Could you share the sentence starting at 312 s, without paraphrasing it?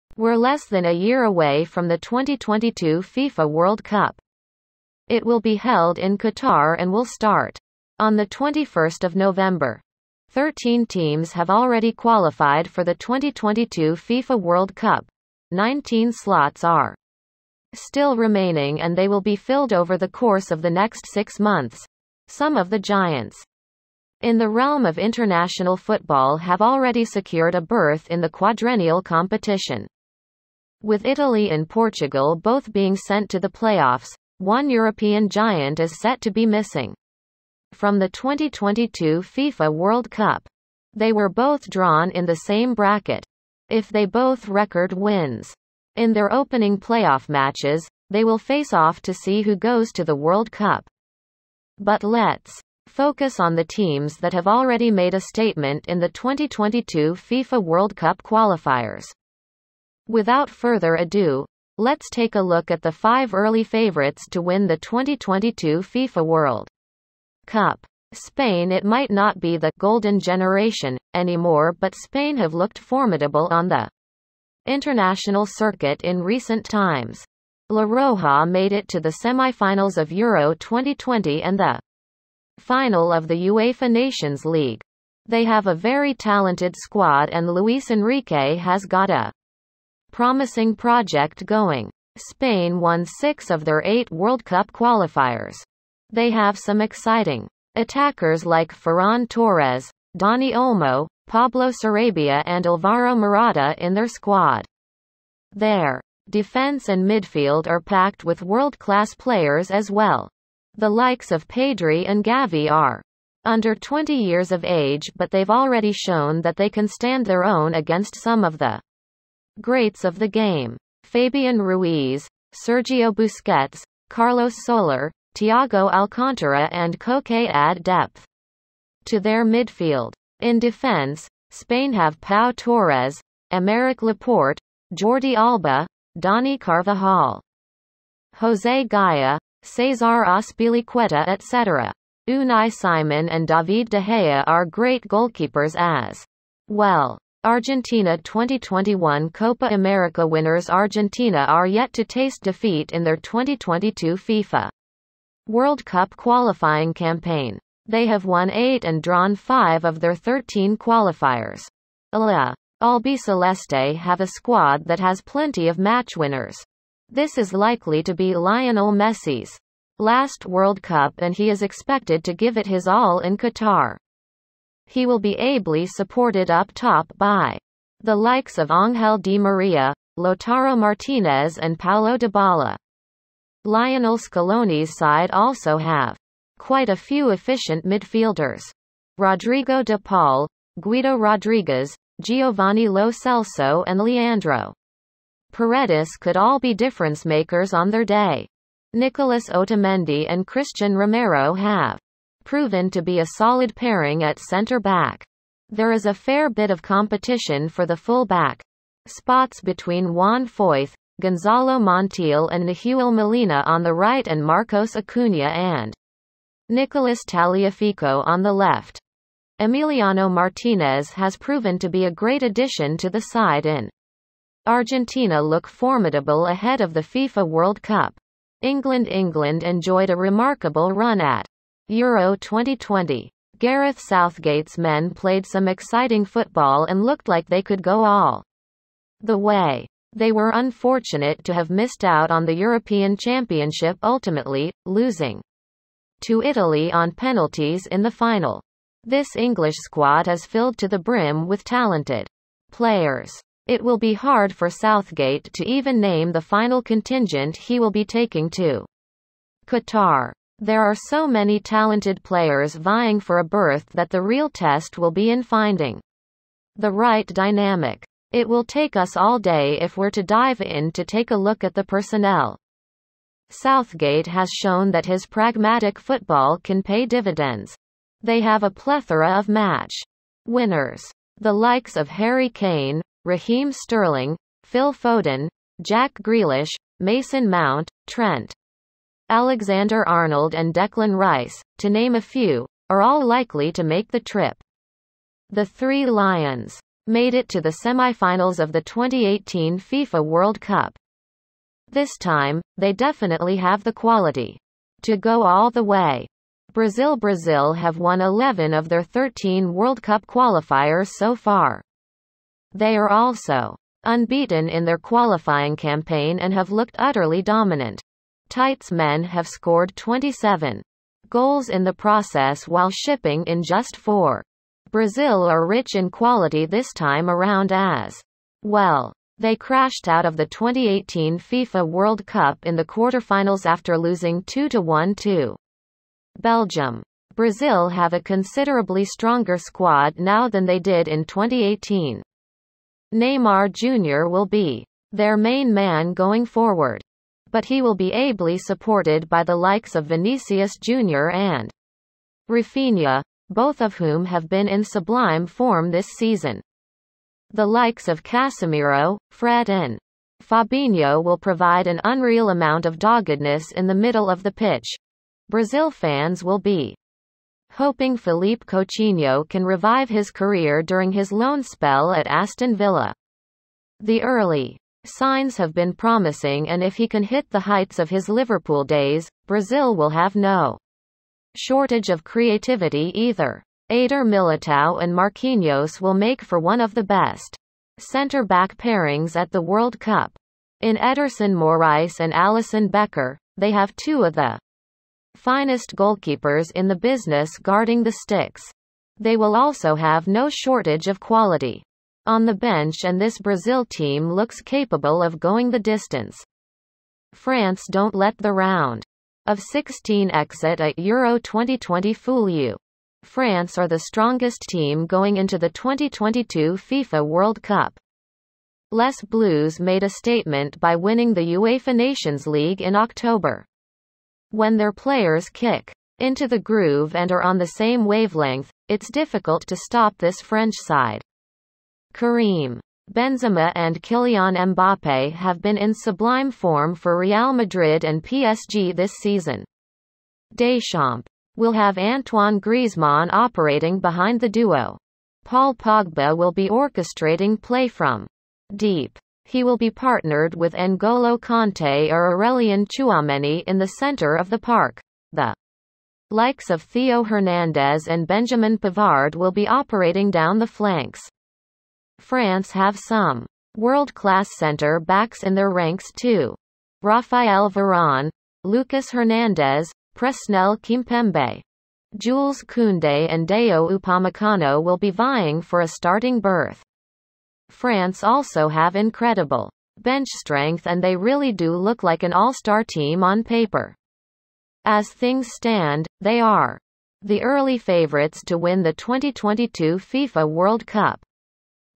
They are also unbeaten in their qualifying campaign and have looked utterly dominant.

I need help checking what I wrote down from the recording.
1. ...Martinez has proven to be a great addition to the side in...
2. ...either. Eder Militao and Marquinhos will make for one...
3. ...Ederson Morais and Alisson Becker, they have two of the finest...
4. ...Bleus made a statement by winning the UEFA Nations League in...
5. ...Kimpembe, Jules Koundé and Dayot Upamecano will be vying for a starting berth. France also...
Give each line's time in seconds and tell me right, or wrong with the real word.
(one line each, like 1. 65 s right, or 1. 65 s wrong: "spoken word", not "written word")
1. 220 s right
2. 383 s right
3. 390 s right
4. 419 s right
5. 470 s right.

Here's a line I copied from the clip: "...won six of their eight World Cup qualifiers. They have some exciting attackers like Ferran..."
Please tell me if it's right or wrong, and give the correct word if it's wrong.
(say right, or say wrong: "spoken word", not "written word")
right.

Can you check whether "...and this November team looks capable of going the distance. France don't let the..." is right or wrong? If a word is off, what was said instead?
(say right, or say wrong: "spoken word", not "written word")
wrong: "Brazil", not "November".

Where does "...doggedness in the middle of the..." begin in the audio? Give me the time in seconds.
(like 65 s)
362 s.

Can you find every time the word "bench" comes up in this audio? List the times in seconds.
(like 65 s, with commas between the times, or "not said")
402 s, 480 s.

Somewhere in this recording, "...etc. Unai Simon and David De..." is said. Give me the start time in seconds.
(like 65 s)
141 s.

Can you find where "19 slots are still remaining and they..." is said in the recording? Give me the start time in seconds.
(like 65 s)
15 s.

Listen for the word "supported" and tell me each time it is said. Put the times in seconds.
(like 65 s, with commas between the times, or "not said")
175 s, 348 s.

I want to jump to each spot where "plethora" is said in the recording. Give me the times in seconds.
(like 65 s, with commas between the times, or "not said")
278 s.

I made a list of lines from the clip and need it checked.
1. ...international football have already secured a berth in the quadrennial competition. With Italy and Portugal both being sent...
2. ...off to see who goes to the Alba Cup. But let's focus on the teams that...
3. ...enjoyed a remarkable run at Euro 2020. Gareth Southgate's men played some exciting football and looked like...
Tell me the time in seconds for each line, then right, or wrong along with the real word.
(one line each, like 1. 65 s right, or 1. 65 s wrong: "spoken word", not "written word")
1. 24 s right
2. 48 s wrong: "World", not "Alba"
3. 229 s right.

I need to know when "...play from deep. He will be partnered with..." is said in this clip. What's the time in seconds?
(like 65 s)
447 s.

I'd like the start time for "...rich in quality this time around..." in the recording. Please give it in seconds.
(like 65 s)
325 s.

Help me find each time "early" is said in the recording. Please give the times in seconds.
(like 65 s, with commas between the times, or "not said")
63 s, 374 s, 487 s.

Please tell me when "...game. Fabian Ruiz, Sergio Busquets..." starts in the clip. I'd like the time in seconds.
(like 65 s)
120 s.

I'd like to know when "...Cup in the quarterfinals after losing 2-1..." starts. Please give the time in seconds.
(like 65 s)
332 s.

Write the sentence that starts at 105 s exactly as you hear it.
Their defense and midfield are packed with world-class players as well.